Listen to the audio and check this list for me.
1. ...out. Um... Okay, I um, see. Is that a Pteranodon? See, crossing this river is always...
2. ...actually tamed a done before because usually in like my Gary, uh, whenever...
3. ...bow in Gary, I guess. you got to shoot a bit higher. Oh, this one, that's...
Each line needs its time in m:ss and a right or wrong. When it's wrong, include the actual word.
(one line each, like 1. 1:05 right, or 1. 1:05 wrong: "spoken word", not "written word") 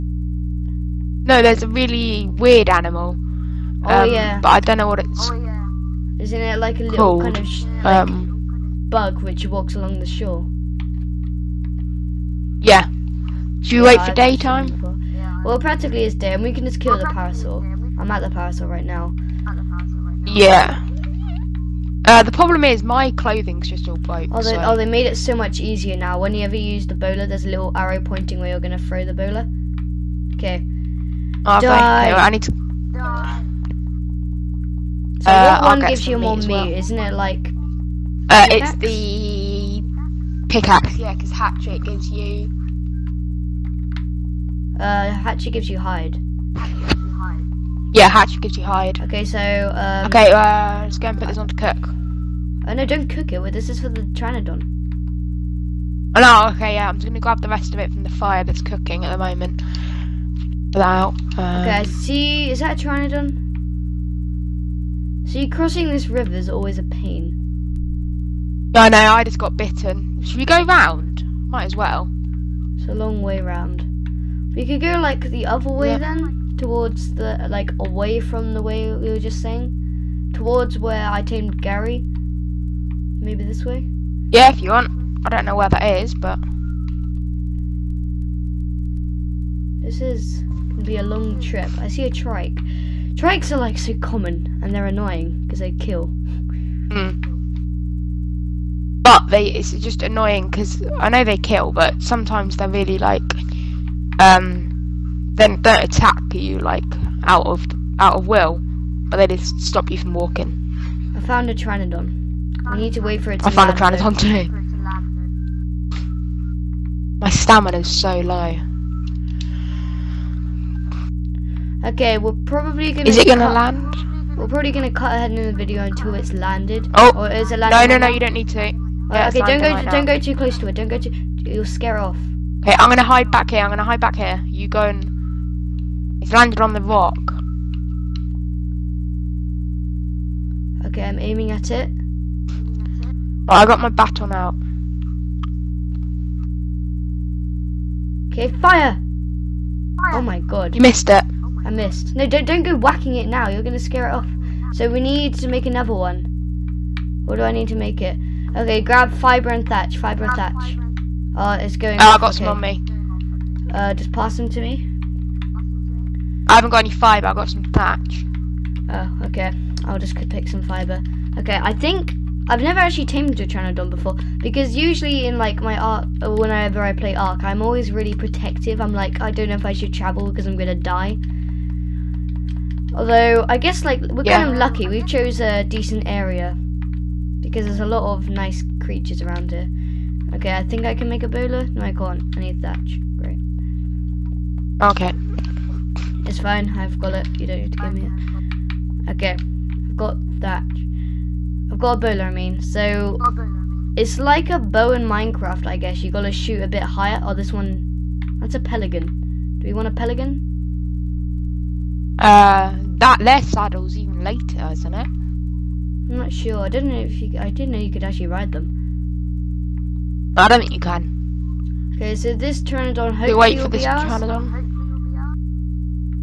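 1. 1:00 right
2. 2:52 wrong: "Ark", not "Gary"
3. 3:24 wrong: "Minecraft", not "Gary".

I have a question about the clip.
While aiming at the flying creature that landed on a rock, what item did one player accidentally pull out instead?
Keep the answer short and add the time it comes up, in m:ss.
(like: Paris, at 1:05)
Baton, at 2:23.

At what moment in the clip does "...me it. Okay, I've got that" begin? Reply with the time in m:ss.
3:17.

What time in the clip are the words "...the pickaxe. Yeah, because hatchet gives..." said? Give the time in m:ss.
0:38.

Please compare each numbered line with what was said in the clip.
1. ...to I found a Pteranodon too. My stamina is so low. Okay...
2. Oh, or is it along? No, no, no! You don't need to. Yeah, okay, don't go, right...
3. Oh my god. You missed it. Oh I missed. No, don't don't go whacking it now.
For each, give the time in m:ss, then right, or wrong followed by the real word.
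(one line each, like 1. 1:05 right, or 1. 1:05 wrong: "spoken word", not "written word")
1. 1:53 right
2. 2:06 wrong: "landing", not "along"
3. 2:30 right.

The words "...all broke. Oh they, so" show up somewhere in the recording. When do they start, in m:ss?
0:23.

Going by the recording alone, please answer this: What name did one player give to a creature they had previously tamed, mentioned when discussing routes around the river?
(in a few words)
Gary.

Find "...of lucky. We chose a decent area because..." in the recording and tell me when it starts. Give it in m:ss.
3:04.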